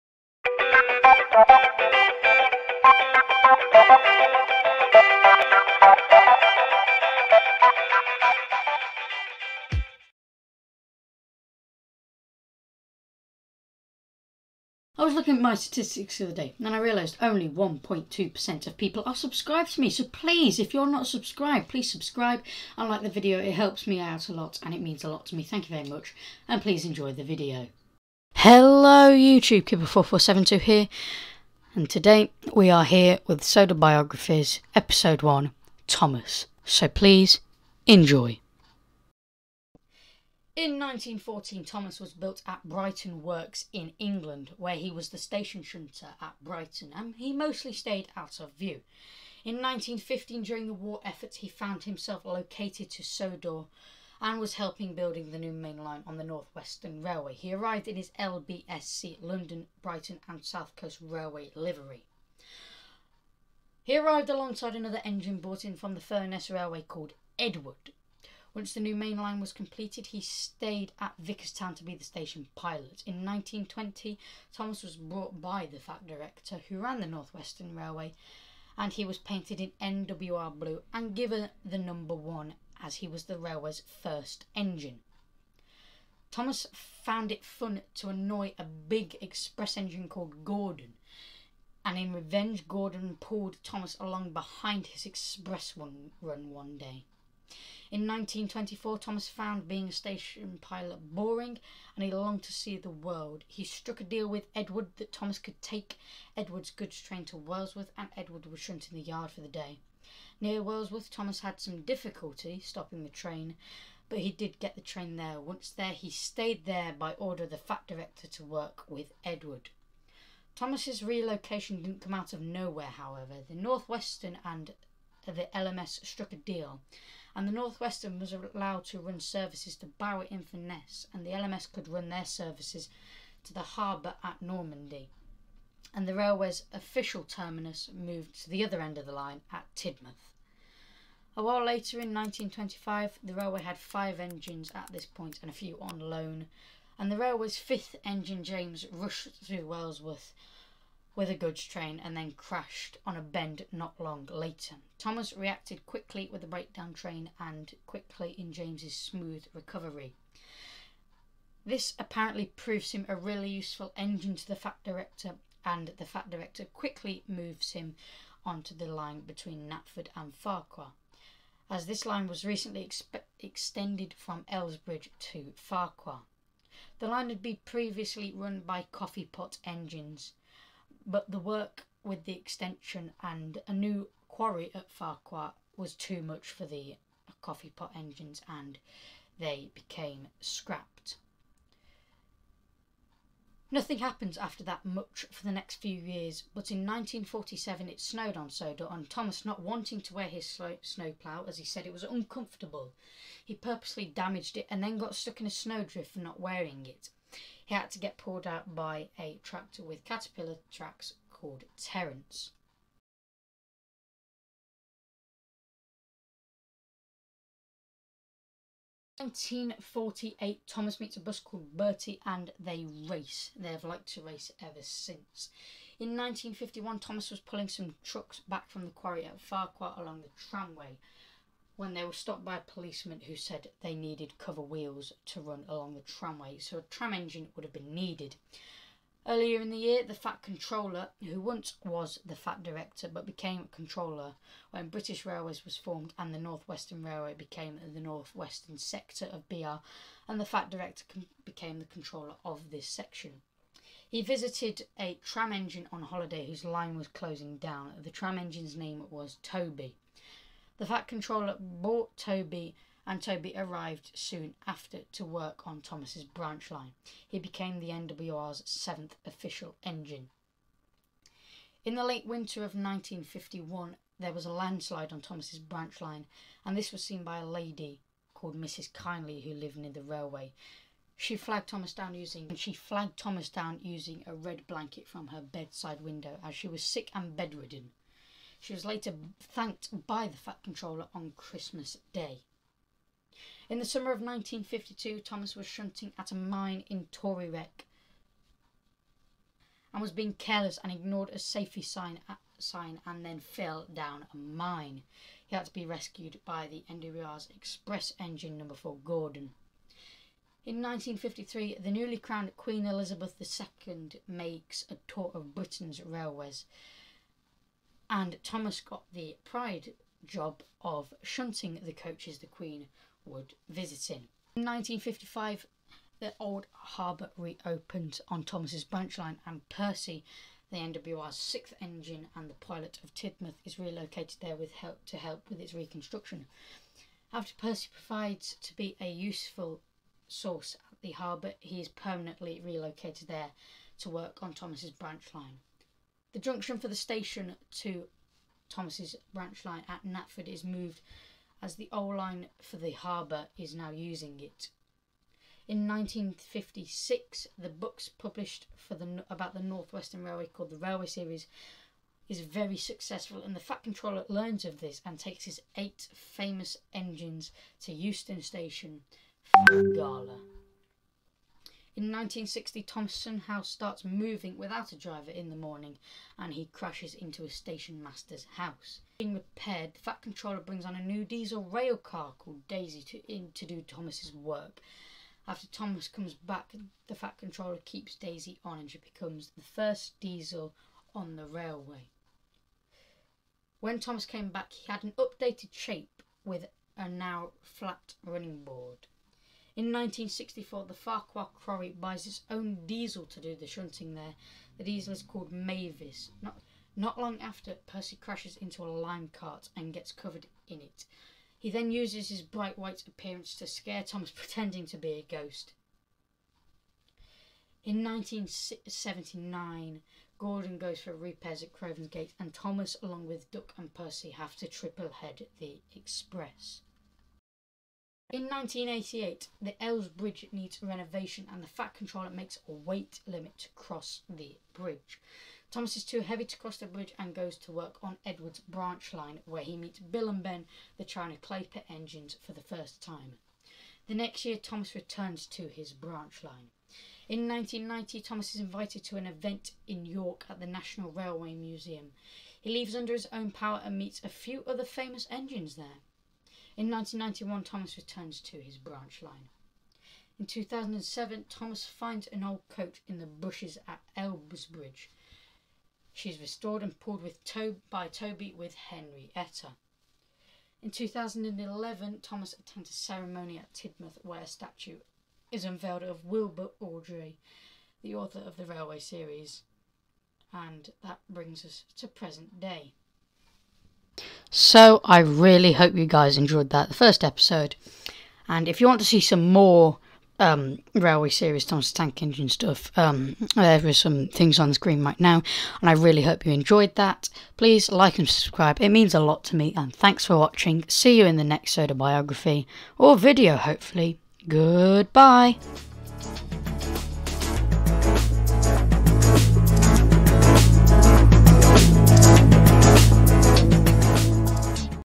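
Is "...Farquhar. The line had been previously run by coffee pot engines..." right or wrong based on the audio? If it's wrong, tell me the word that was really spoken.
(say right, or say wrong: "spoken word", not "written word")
right.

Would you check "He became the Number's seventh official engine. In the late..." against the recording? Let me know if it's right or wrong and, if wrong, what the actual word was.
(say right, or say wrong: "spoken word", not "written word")
wrong: "NWR", not "Number".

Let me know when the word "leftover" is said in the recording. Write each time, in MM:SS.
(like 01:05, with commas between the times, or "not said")
not said.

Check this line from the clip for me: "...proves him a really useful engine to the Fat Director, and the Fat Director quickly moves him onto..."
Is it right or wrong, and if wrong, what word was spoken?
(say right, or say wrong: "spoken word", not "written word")
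right.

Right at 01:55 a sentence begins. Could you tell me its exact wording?
Once there, he stayed there by order of the fat director to work with Edward.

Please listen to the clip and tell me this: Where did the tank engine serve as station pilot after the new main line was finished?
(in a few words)
Vickerstown.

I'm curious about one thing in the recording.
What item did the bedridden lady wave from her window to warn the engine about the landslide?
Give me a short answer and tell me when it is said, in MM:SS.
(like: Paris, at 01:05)
a red blanket, at 04:44.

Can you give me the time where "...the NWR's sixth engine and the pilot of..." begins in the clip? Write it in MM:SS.
05:30.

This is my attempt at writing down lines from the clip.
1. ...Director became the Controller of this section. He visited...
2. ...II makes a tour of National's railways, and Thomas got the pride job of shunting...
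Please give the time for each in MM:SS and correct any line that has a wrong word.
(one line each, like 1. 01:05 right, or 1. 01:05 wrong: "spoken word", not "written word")
1. 04:10 right
2. 05:13 wrong: "Britain", not "National".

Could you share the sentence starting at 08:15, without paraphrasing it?
And I really hope you enjoyed that.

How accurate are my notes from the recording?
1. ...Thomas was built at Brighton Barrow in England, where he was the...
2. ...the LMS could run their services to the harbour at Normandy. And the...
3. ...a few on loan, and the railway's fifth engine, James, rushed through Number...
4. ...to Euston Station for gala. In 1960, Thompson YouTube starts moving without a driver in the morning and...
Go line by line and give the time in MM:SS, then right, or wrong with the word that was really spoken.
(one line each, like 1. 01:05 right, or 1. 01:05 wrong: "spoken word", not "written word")
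1. 00:41 wrong: "Works", not "Barrow"
2. 02:11 right
3. 02:25 wrong: "Wellsworth", not "Number"
4. 06:07 wrong: "House", not "YouTube".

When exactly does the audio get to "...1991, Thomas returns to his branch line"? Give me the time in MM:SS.
07:36.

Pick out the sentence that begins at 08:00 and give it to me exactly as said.
And that brings us to present day.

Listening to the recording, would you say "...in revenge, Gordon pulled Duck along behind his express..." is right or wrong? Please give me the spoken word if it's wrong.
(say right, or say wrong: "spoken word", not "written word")
wrong: "Thomas", not "Duck".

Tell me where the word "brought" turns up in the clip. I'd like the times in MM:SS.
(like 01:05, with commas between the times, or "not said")
01:05, 01:14.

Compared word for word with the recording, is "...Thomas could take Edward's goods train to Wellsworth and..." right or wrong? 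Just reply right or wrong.
right.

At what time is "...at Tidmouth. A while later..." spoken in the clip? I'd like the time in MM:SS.
02:19.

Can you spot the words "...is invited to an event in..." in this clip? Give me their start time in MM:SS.
07:28.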